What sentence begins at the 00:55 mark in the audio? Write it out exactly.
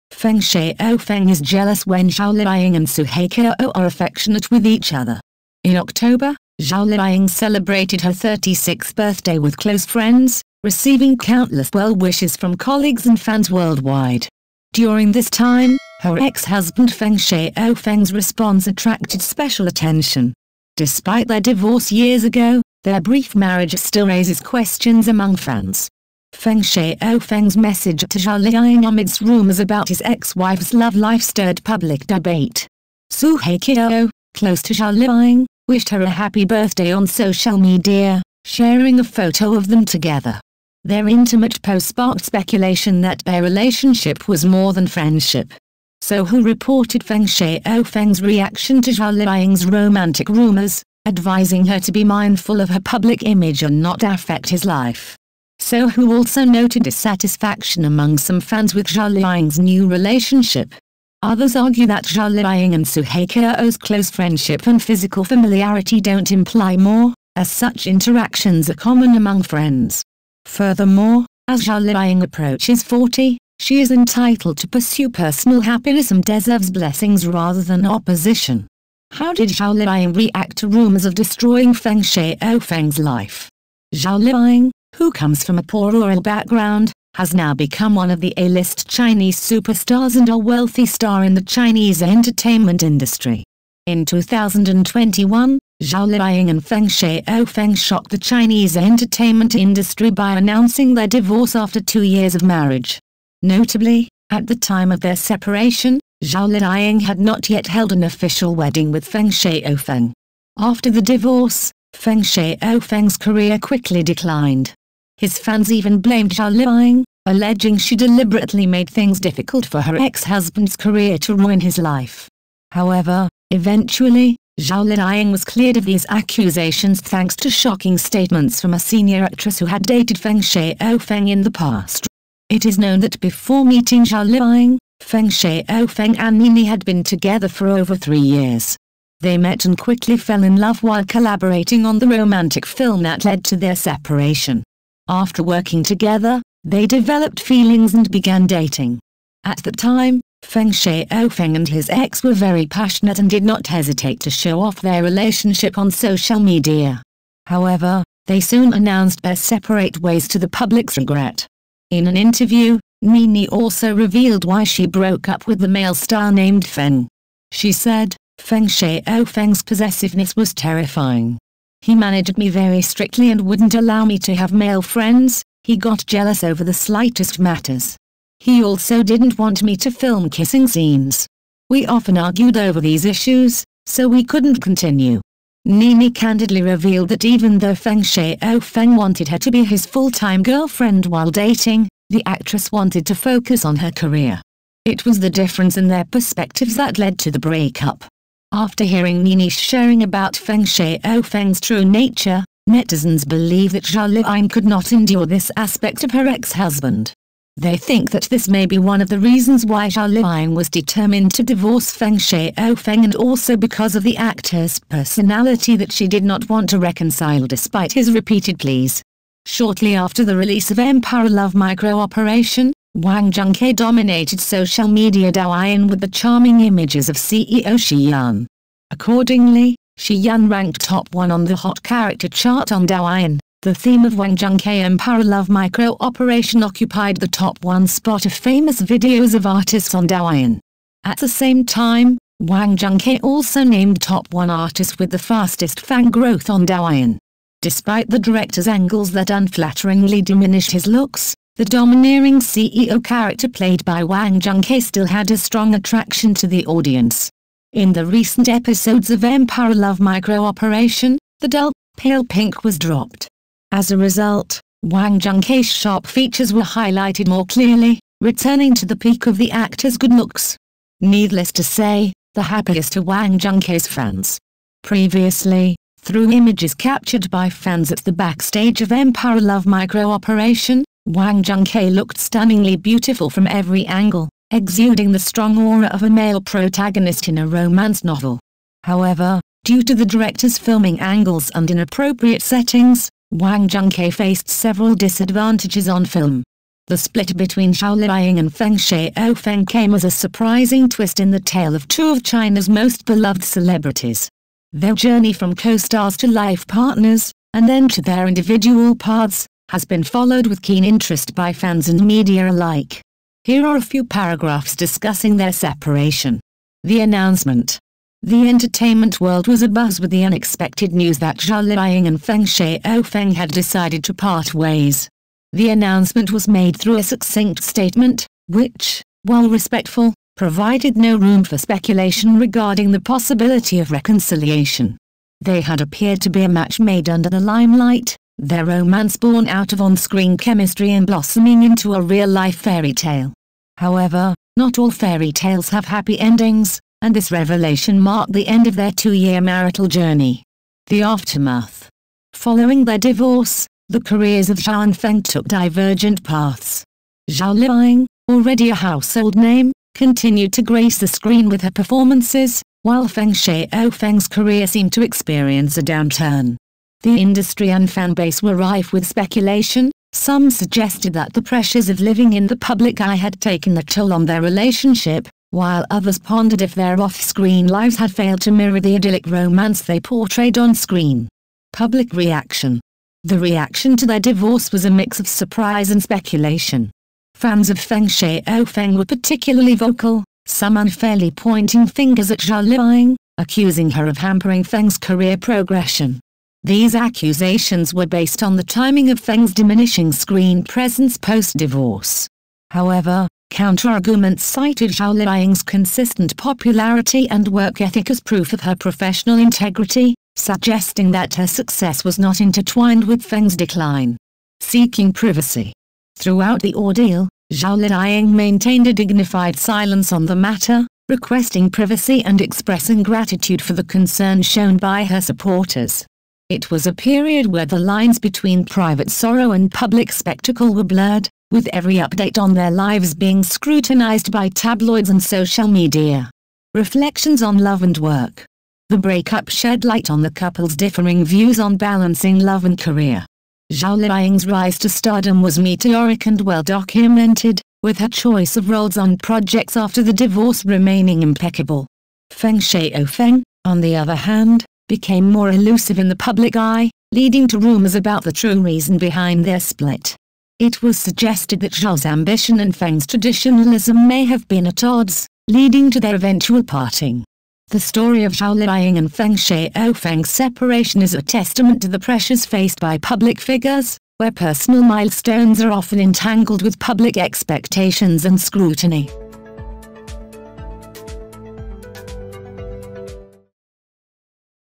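Sohu also noted dissatisfaction among some fans with Zhao Liying's new relationship.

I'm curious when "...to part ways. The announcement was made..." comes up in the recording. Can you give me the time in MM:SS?
05:24.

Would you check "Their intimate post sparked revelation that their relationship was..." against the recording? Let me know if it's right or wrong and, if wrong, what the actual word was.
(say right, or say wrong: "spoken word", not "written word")
wrong: "speculation", not "revelation".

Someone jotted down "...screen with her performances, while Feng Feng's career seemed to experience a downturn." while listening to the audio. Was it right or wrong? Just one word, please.
right.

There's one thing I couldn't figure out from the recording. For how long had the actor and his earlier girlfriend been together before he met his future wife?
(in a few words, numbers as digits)
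over three years.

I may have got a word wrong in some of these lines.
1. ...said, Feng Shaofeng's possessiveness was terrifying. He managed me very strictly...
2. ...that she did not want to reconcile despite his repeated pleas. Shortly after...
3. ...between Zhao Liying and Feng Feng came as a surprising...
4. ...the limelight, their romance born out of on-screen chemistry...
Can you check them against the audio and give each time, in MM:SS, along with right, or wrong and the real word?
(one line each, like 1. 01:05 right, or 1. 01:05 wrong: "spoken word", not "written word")
1. 02:47 right
2. 03:35 right
3. 04:57 right
4. 05:37 right.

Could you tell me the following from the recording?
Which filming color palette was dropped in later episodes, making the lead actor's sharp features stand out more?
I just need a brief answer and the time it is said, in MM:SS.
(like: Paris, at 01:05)
pale pink, at 04:21.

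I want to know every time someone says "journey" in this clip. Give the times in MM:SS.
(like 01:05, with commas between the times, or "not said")
05:04, 05:49.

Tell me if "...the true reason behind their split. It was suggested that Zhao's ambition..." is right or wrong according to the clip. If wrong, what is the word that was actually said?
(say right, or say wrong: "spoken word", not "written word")
right.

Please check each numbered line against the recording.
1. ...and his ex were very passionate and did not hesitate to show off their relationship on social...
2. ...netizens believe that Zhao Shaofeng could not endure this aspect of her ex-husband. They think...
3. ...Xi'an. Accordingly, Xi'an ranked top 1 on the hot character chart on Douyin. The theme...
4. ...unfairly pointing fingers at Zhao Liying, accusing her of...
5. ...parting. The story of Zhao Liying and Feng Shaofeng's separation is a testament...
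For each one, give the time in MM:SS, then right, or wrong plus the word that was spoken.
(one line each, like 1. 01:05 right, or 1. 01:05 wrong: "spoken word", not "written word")
1. 02:31 right
2. 03:22 wrong: "Liying", not "Shaofeng"
3. 03:47 right
4. 06:30 right
5. 07:46 right.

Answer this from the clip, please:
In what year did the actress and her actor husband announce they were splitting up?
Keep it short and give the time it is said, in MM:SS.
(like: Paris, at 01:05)
2021, at 01:34.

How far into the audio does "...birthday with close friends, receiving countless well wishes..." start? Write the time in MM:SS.
00:08.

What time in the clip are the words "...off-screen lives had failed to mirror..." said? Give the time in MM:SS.
06:17.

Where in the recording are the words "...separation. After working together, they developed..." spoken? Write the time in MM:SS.
02:23.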